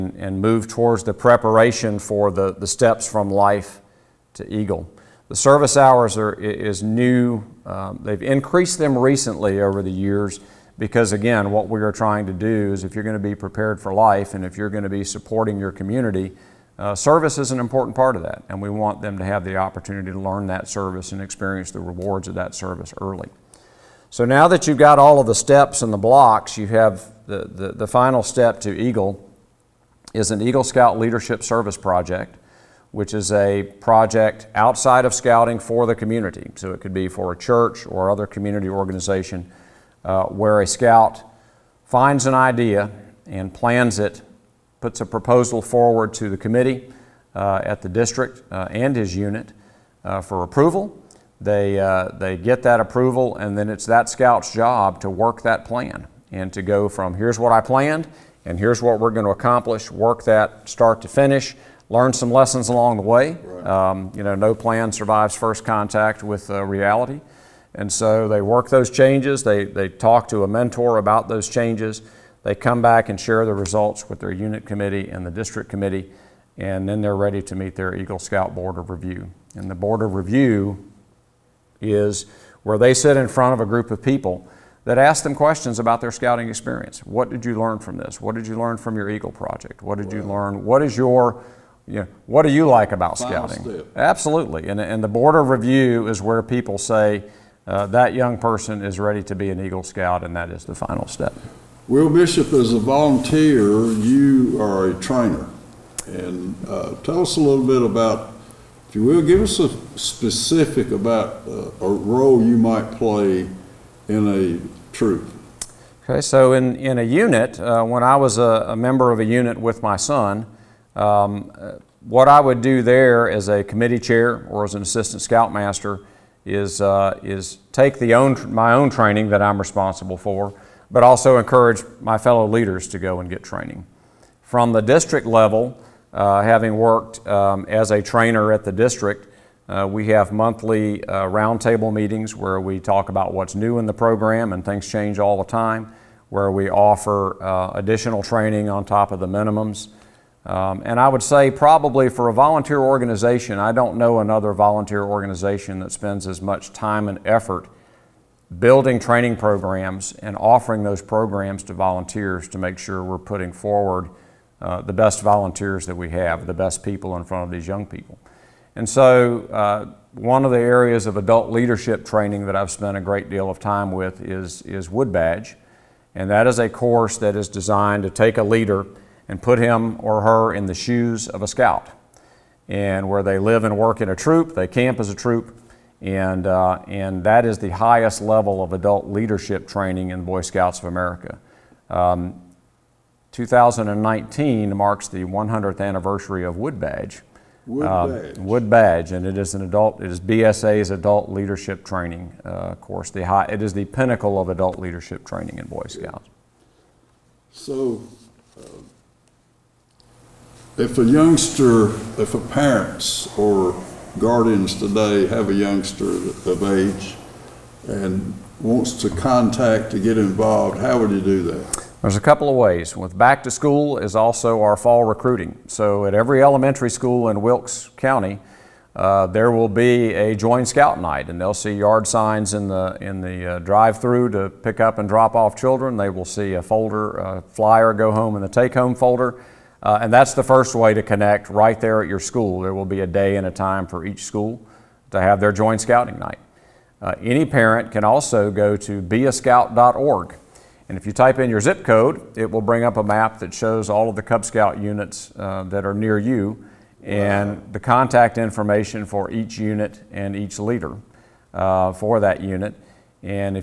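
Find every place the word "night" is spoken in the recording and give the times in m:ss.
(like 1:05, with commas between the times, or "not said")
3:50, 4:06.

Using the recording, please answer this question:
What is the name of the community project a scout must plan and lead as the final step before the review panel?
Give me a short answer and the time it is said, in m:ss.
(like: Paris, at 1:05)
Eagle Scout Leadership Service Project, at 0:30.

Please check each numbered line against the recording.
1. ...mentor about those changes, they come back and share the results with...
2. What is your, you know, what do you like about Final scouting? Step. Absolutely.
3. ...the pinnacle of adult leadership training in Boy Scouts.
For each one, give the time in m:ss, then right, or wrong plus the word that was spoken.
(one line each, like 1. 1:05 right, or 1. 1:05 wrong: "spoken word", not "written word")
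1. 1:10 right
2. 1:30 right
3. 3:23 right.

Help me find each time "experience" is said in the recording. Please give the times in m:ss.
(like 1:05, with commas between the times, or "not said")
0:21, 1:26.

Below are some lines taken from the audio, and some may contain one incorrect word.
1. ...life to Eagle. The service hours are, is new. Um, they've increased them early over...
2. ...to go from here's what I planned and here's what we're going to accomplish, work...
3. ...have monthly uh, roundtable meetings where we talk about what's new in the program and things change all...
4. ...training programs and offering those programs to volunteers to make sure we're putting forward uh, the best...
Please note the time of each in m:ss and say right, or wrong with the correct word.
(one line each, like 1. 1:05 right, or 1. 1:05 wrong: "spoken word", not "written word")
1. 0:03 wrong: "recently", not "early"
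2. 0:56 right
3. 2:20 right
4. 2:38 right.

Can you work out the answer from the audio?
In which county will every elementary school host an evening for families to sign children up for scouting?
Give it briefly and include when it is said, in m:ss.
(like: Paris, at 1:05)
Wilkes County, at 3:47.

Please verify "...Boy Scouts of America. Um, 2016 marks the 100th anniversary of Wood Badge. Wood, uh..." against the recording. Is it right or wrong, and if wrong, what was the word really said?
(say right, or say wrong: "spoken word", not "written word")
wrong: "2019", not "2016".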